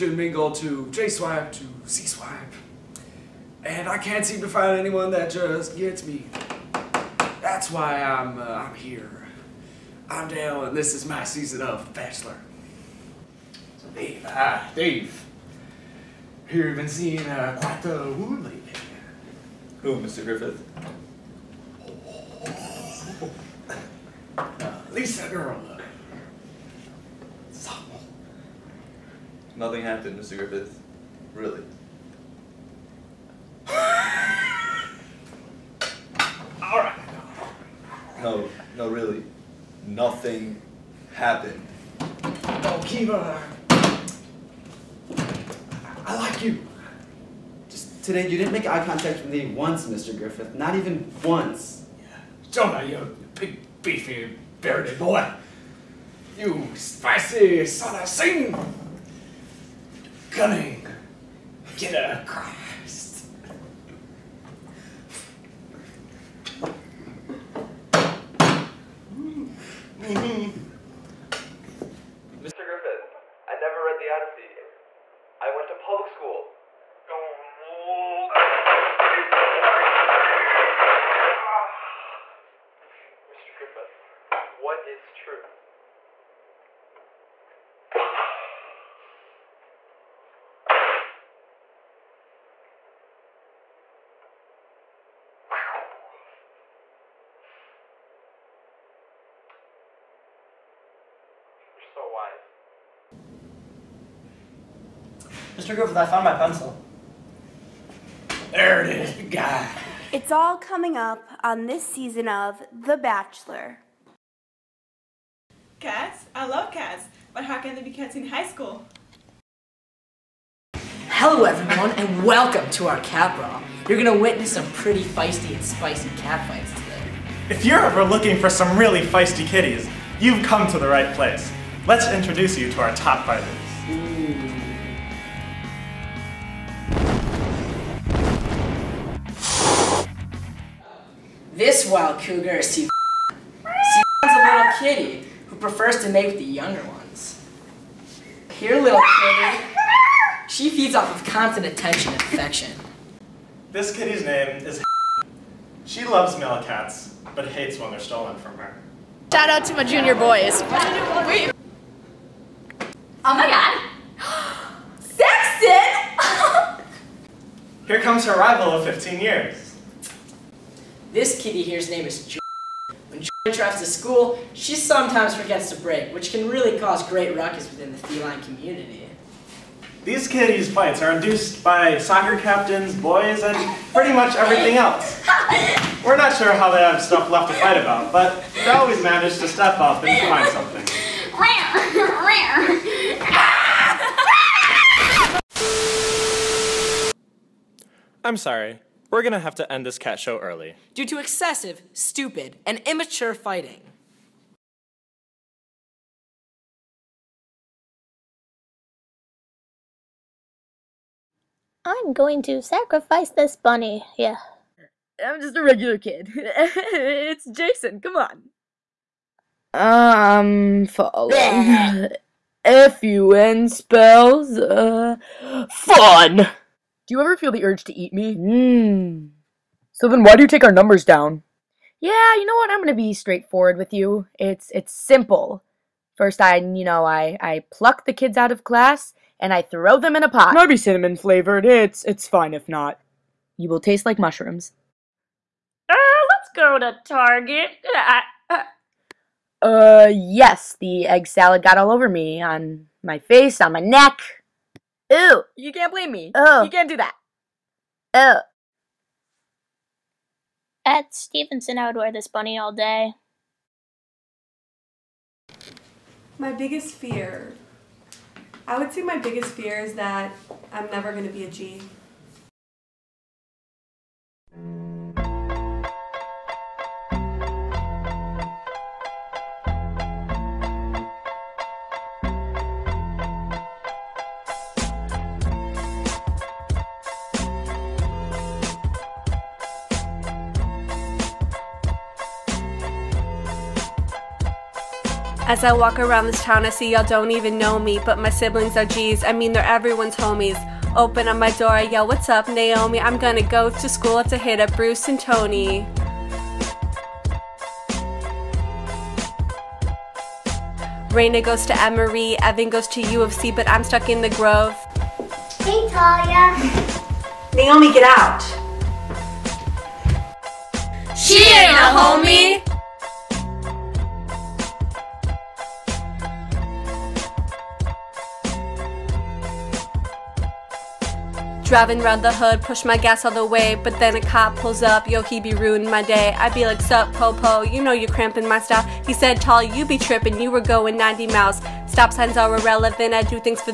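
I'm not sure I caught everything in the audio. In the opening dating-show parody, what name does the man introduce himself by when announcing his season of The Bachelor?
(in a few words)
Dale.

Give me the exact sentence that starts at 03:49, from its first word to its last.
So then why do you take our numbers down?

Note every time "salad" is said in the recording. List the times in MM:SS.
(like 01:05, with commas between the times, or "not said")
04:11.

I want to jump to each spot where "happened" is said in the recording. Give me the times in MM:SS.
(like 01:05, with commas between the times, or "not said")
00:29, 00:41.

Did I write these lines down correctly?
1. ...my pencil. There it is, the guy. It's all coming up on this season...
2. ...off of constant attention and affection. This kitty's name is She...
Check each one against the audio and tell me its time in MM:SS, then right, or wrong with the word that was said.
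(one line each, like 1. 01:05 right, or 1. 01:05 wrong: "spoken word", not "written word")
1. 01:46 right
2. 02:30 right.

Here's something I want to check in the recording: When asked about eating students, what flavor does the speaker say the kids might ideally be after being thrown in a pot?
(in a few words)
Cinnamon.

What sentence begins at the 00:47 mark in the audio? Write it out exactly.
Just today, you didn't make eye contact with me once, Mr.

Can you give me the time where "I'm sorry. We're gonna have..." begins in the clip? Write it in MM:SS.
03:18.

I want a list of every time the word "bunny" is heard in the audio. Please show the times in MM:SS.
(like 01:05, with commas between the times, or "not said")
03:33, 04:22.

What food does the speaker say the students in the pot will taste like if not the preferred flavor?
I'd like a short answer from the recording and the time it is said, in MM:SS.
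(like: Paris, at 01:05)
Mushrooms, at 04:04.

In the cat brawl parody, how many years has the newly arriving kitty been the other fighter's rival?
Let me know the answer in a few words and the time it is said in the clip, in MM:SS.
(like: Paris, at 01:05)
15, at 02:48.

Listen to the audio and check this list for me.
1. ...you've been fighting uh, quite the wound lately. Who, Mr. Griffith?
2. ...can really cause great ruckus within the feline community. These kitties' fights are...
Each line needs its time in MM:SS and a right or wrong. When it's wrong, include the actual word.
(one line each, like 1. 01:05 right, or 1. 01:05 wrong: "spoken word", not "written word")
1. 00:16 wrong: "seeing", not "fighting"
2. 02:56 right.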